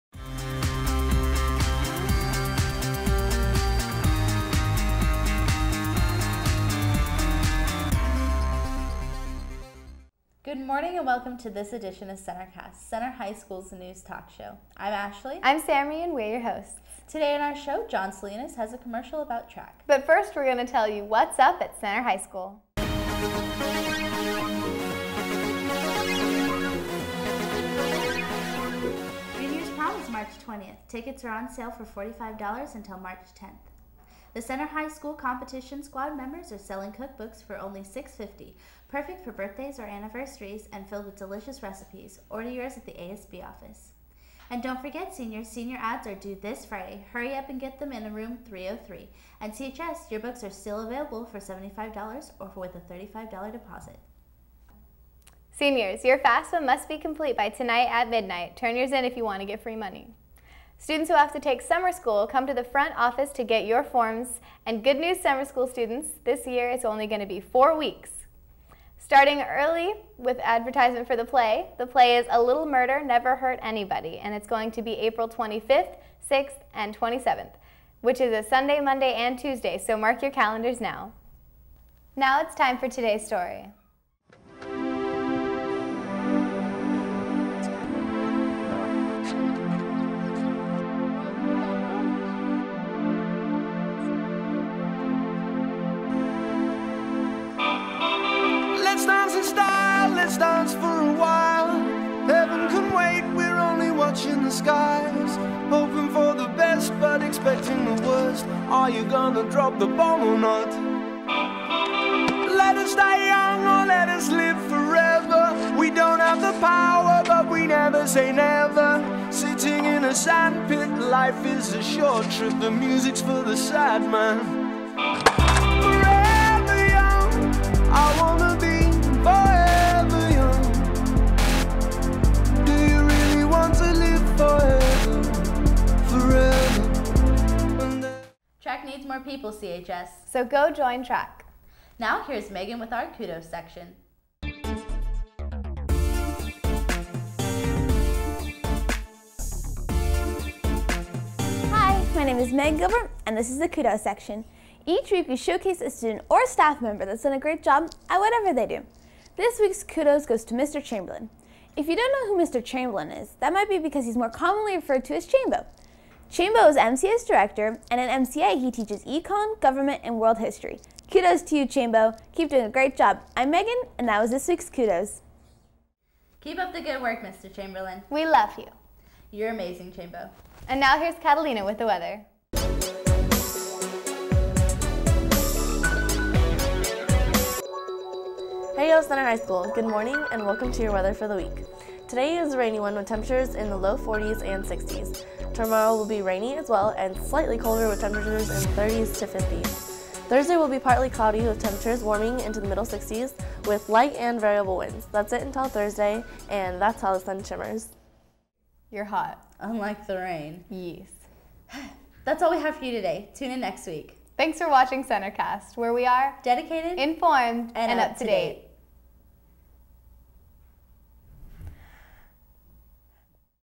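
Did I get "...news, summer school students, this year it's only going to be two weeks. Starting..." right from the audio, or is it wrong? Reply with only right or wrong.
wrong.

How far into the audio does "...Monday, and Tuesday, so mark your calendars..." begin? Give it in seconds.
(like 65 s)
78 s.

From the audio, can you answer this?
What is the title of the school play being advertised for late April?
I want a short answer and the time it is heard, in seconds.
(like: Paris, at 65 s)
A Little Murder Never Hurt Anybody, at 72 s.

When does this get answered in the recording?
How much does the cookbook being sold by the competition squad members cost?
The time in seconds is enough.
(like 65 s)
37 s.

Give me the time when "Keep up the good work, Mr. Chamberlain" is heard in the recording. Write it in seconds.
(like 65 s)
176 s.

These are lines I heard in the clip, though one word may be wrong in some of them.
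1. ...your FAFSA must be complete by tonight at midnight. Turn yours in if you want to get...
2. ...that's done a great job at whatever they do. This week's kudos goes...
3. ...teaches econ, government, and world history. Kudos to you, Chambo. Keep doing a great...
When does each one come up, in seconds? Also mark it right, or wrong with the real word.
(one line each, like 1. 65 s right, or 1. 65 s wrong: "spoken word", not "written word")
1. 56 s right
2. 157 s right
3. 168 s right.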